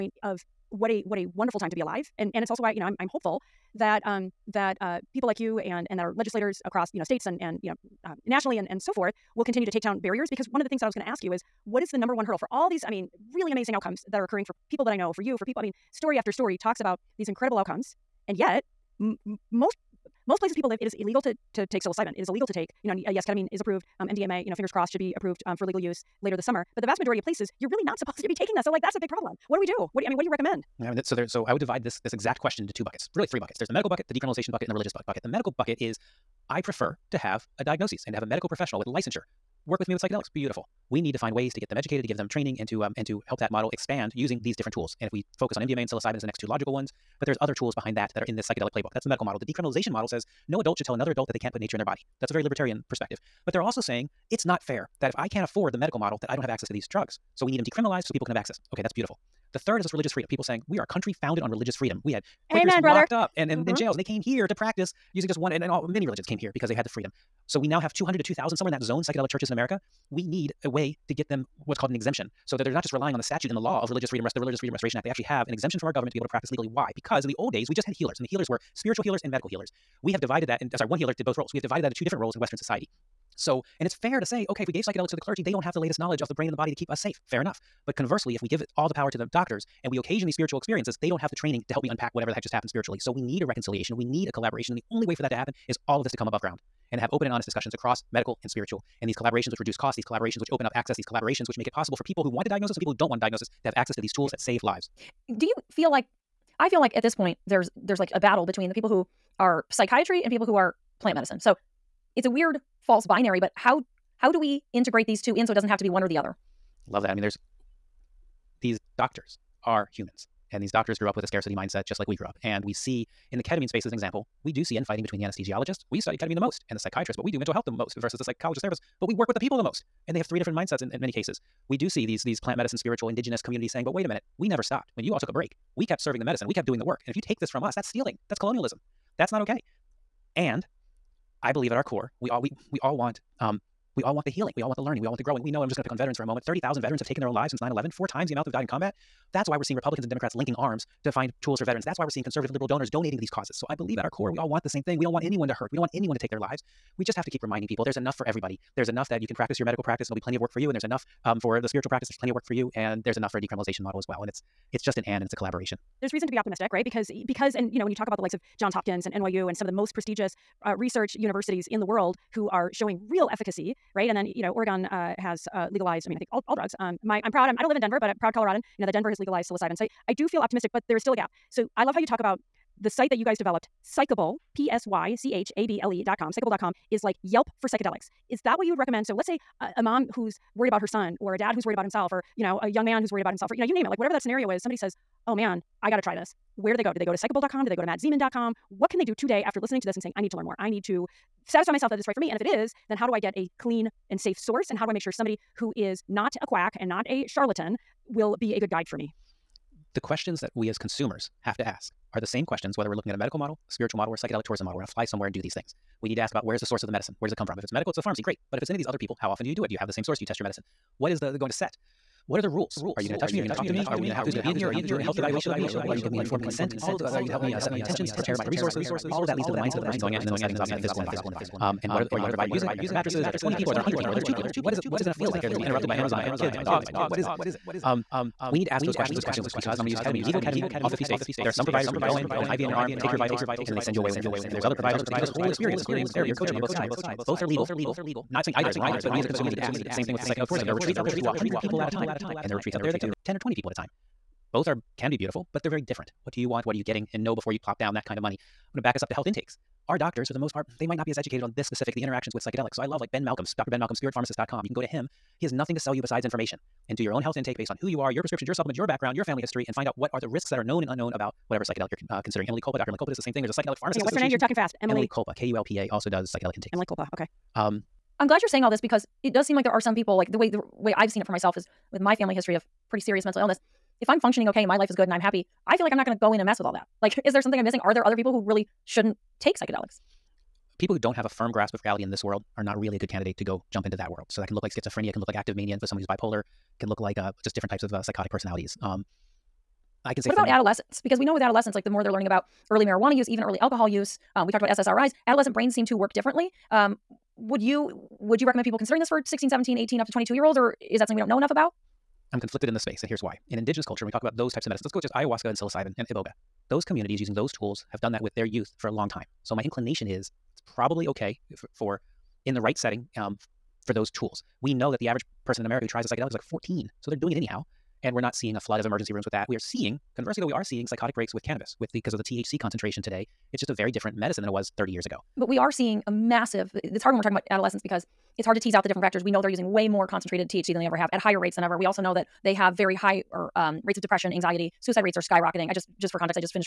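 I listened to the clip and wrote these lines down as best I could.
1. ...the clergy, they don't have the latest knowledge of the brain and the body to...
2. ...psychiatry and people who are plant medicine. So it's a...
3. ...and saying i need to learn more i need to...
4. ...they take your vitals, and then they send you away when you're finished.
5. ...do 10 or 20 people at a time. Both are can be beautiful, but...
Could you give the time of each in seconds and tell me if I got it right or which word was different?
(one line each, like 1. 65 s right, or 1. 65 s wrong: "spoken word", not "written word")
1. 85 s right
2. 109 s right
3. 199 s right
4. 242 s right
5. 253 s right.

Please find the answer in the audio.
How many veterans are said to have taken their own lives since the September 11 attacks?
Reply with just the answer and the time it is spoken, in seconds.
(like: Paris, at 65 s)
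30,000, at 146 s.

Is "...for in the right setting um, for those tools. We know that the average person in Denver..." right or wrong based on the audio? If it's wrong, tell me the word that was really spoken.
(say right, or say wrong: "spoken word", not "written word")
wrong: "America", not "Denver".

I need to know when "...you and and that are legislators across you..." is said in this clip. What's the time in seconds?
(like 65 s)
5 s.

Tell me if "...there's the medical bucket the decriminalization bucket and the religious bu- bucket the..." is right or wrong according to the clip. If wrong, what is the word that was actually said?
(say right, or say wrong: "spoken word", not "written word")
right.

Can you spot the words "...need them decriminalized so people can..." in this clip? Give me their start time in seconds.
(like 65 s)
57 s.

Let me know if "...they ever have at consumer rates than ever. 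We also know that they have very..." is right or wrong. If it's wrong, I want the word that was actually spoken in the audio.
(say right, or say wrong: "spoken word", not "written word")
wrong: "higher", not "consumer".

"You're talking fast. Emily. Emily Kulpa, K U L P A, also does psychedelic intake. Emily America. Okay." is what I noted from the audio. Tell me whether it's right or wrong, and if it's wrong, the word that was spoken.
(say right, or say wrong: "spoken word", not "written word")
wrong: "Kulpa", not "America".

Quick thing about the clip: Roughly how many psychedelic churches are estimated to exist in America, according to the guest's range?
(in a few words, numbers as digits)
200 to 2,000.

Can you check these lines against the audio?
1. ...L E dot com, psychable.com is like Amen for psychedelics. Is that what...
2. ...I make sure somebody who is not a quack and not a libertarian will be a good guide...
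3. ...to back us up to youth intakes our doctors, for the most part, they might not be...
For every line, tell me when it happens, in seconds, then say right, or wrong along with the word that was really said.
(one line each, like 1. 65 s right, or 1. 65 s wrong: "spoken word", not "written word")
1. 185 s wrong: "Yelp", not "Amen"
2. 204 s wrong: "charlatan", not "libertarian"
3. 258 s wrong: "health", not "youth".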